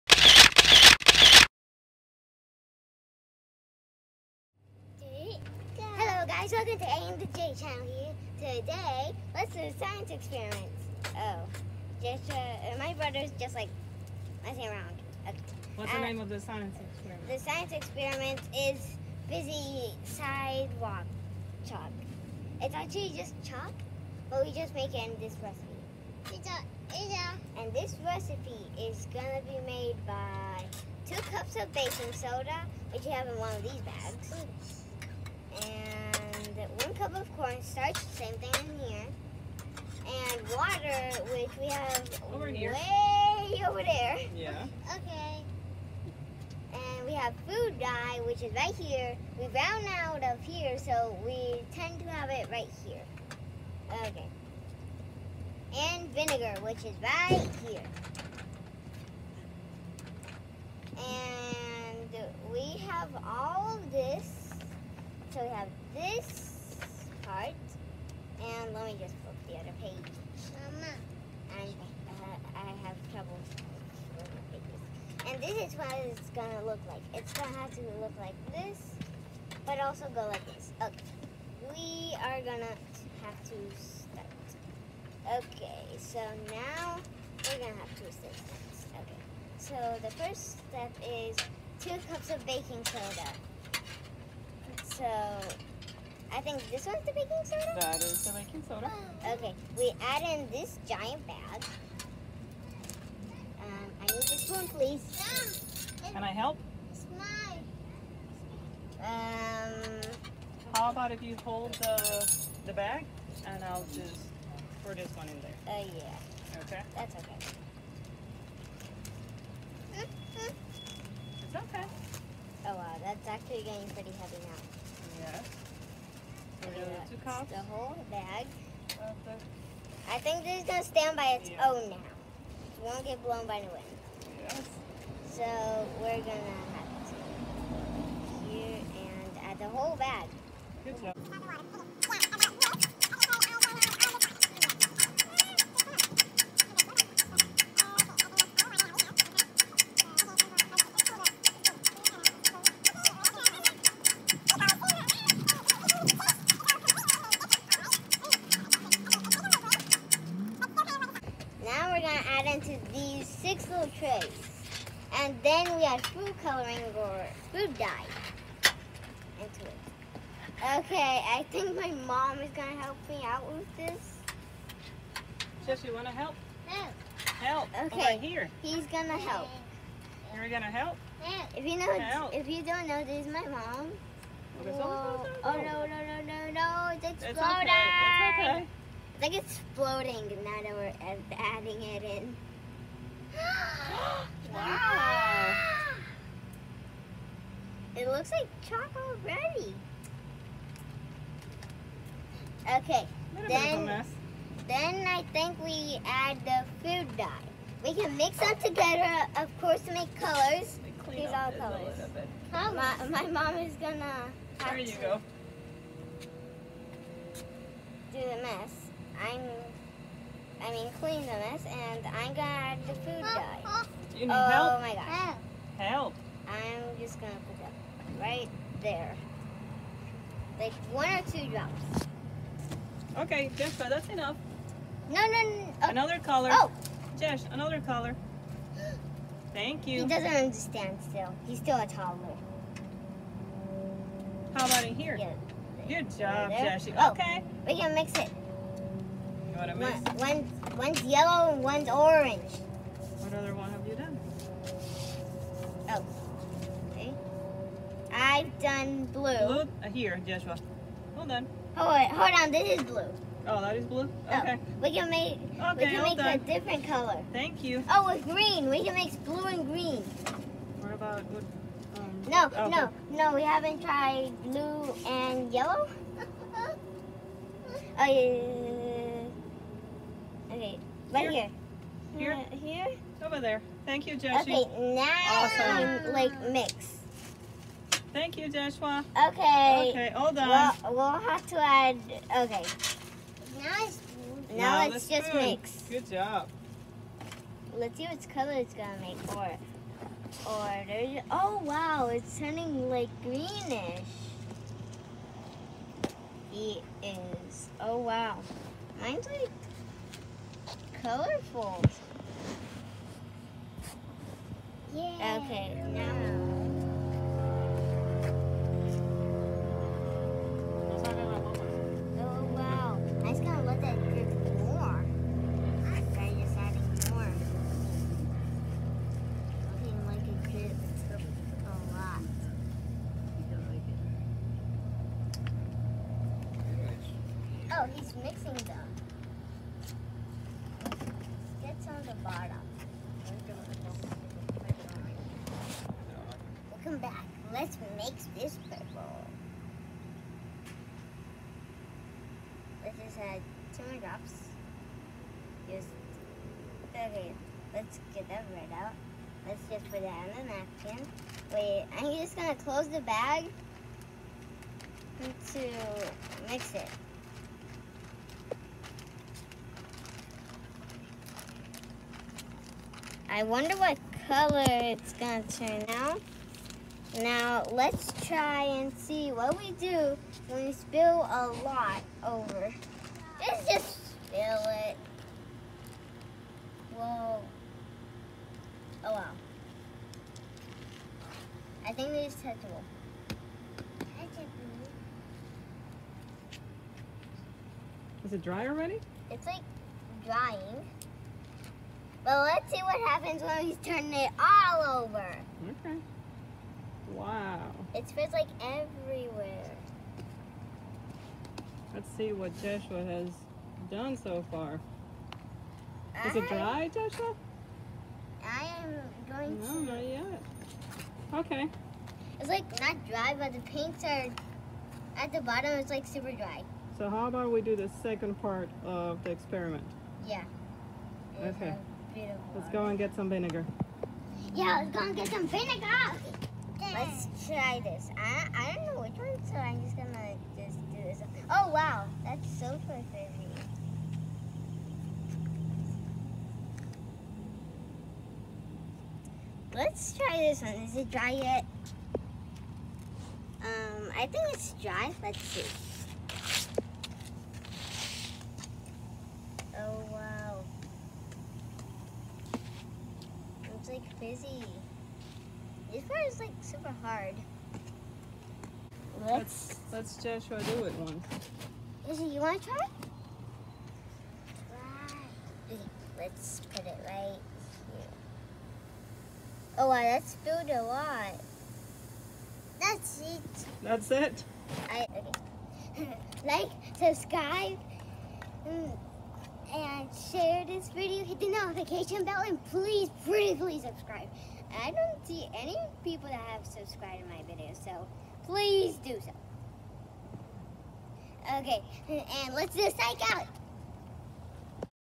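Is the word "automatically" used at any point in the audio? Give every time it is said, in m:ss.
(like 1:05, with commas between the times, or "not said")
not said.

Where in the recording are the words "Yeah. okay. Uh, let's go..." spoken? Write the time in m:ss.
7:10.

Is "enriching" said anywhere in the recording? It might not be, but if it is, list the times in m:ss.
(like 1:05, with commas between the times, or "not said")
not said.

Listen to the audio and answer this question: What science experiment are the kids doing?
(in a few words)
Fizzy sidewalk chalk.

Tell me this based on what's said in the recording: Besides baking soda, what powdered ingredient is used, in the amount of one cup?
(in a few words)
Cornstarch.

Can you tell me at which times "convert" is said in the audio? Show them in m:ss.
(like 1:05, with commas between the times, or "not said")
not said.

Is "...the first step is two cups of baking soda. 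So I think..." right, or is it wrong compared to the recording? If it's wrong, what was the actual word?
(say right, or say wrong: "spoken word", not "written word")
right.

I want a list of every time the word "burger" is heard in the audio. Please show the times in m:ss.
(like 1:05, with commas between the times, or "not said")
not said.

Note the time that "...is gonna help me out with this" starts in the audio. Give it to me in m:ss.
2:52.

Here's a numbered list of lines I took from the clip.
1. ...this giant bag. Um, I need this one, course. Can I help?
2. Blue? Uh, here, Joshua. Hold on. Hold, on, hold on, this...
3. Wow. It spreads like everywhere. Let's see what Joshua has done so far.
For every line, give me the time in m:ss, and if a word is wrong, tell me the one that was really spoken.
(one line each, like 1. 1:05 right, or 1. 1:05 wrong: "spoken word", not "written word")
1. 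1:40 wrong: "please", not "course"
2. 4:19 right
3. 6:47 right.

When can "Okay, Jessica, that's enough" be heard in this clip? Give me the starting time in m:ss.
3:53.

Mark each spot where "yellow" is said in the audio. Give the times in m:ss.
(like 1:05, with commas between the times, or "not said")
4:11, 4:35.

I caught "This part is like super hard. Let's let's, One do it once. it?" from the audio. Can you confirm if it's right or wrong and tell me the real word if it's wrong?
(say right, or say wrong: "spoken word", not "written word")
wrong: "Joshua", not "One".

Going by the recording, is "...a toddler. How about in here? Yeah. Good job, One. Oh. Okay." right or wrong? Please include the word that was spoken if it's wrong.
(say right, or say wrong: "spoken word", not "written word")
wrong: "Jesse", not "One".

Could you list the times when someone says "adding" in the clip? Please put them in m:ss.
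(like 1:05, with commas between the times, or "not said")
3:11, 5:25.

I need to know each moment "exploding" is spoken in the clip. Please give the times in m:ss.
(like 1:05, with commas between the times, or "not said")
3:07.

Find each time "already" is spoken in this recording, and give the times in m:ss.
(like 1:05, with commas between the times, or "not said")
3:19, 6:38.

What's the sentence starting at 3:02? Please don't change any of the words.
if you don't know, this is my mom.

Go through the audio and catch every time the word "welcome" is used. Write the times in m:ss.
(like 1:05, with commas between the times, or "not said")
0:06.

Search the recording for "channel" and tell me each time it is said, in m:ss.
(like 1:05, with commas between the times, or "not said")
0:07.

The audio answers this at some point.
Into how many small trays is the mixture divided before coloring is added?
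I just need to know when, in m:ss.
2:43.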